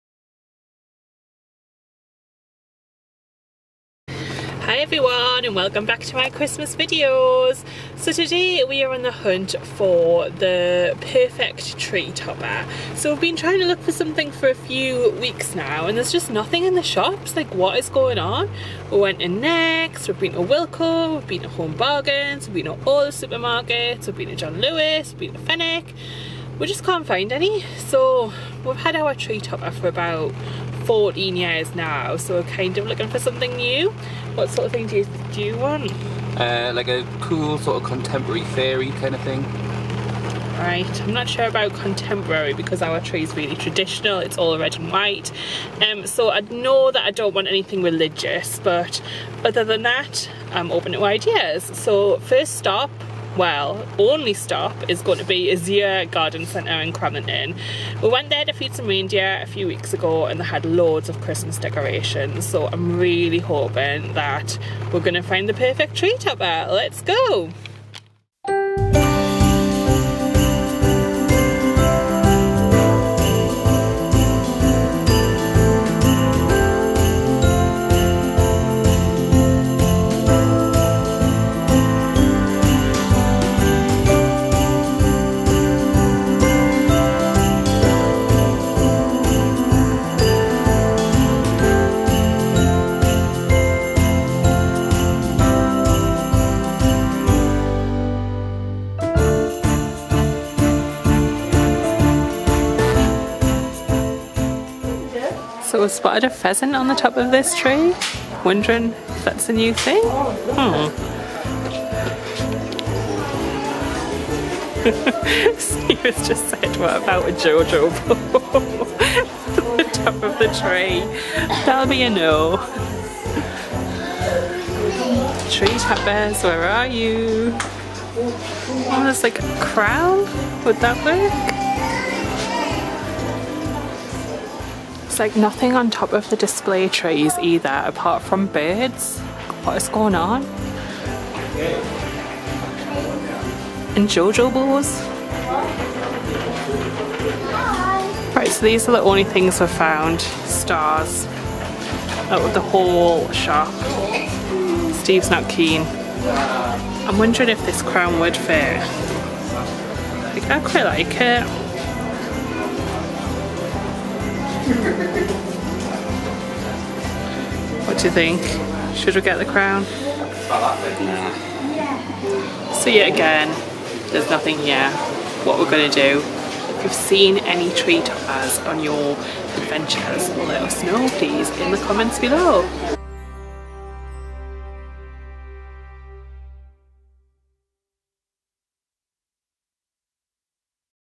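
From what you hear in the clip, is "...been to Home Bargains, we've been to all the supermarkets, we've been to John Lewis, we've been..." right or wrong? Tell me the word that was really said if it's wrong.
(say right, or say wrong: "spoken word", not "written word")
right.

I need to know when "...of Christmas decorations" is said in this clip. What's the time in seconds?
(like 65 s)
61 s.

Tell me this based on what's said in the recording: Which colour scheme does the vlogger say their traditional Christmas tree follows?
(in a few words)
red and white.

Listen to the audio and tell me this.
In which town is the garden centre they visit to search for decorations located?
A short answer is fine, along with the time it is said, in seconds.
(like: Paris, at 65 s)
Cramlington, at 56 s.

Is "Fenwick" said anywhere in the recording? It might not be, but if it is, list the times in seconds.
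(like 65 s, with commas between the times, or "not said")
25 s.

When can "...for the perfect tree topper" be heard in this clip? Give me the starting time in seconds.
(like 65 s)
9 s.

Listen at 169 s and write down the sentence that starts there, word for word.
See So yet again, there's nothing here.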